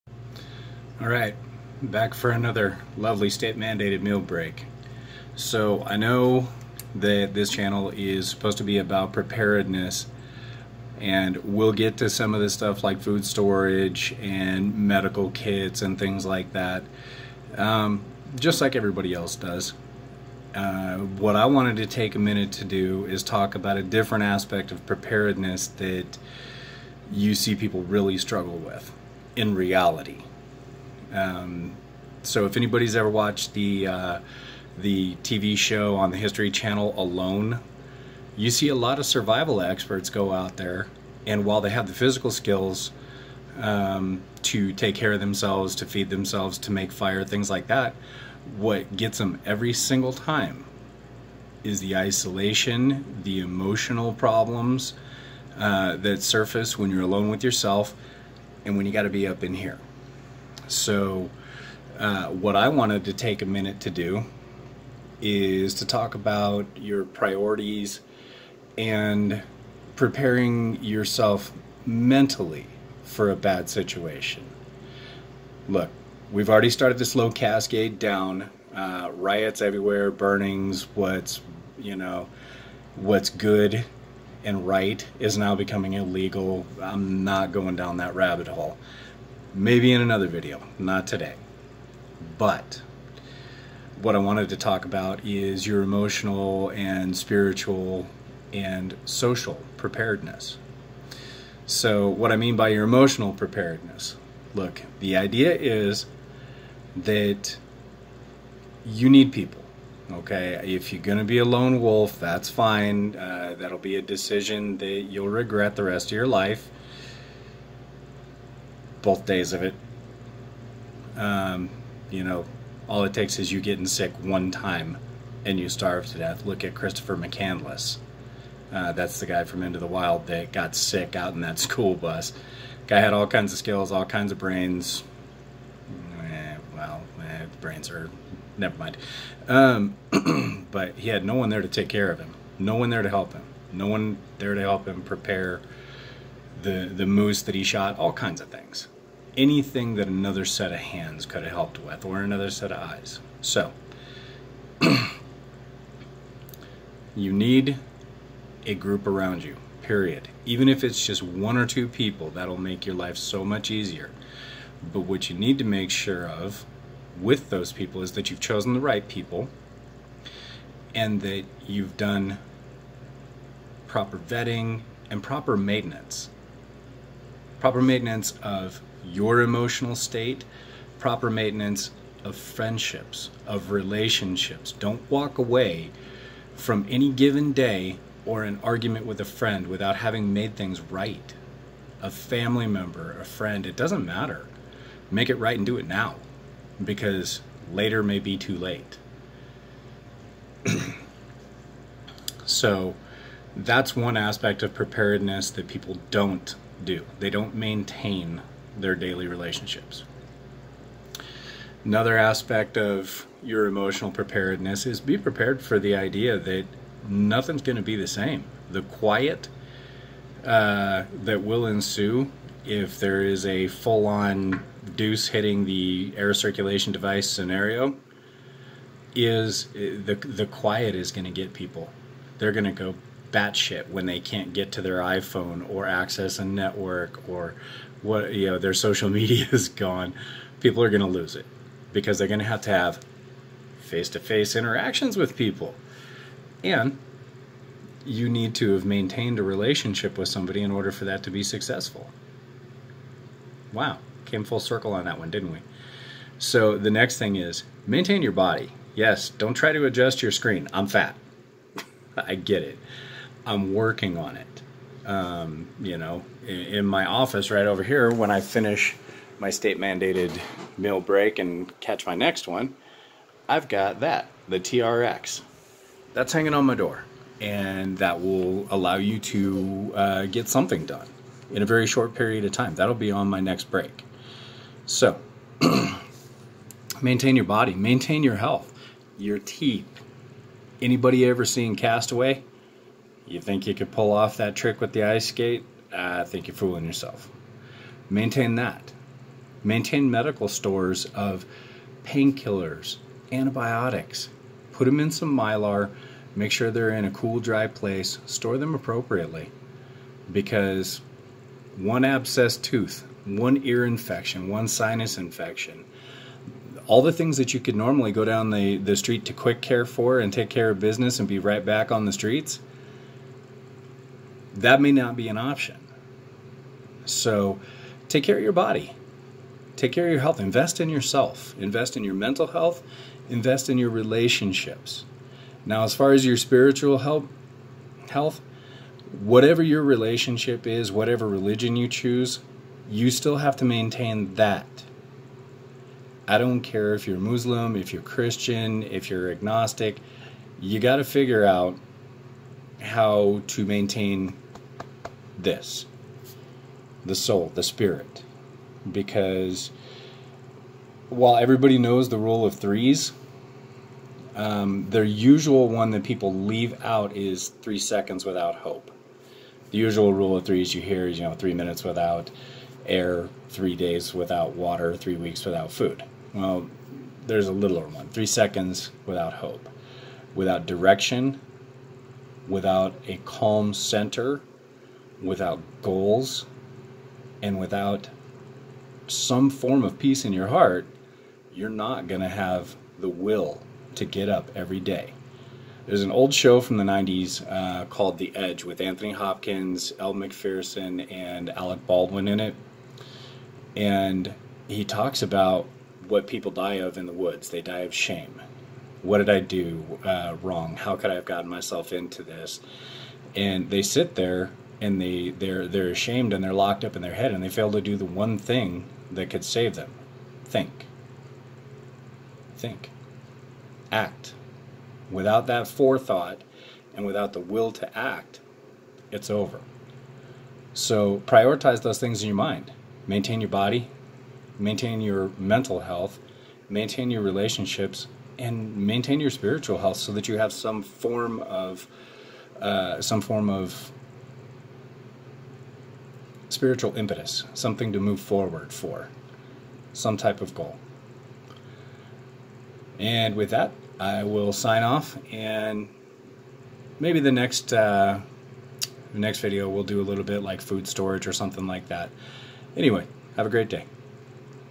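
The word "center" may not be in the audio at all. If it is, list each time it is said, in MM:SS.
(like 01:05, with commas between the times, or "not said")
06:23.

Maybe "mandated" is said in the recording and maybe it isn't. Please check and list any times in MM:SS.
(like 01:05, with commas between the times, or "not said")
00:03, 04:29.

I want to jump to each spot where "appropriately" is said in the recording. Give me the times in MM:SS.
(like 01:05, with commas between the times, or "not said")
05:08.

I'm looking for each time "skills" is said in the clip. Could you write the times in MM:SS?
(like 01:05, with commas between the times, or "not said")
00:42, 02:13.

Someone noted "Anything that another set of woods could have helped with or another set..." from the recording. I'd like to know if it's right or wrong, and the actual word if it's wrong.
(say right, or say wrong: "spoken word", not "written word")
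wrong: "hands", not "woods".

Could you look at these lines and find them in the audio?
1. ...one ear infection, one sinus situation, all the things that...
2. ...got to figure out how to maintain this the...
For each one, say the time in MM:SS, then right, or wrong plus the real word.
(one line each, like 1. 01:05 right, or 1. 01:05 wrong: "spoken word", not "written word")
1. 05:13 wrong: "infection", not "situation"
2. 05:50 right.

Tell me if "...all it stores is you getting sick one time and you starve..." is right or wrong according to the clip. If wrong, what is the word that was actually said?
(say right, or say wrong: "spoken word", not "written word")
wrong: "takes", not "stores".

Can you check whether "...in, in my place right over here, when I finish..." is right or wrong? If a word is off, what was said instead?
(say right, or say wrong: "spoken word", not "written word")
wrong: "office", not "place".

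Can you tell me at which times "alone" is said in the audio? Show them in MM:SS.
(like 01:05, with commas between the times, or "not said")
00:36, 00:57.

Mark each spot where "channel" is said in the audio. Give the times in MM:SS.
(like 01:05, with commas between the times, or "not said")
00:07, 00:36.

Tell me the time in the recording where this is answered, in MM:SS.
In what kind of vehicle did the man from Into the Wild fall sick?
02:11.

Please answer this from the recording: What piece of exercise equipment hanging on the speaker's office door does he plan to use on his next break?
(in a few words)
TRX.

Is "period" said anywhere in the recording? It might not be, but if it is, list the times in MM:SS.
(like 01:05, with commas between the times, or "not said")
02:39, 04:42.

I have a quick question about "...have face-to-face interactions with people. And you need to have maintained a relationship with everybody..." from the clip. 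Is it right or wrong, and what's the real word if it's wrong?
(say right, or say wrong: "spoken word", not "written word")
wrong: "somebody", not "everybody".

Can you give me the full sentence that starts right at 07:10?
So prioritize those things in your mind.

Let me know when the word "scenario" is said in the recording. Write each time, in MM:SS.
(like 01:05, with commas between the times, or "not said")
03:47.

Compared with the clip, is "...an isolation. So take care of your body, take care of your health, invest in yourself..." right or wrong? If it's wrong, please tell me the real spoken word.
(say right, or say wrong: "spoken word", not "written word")
wrong: "option", not "isolation".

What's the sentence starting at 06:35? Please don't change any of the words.
There's an old show from the 90s uh, called The Edge with Anthony Hopkins, Elle Macpherson, and Alec Baldwin in it.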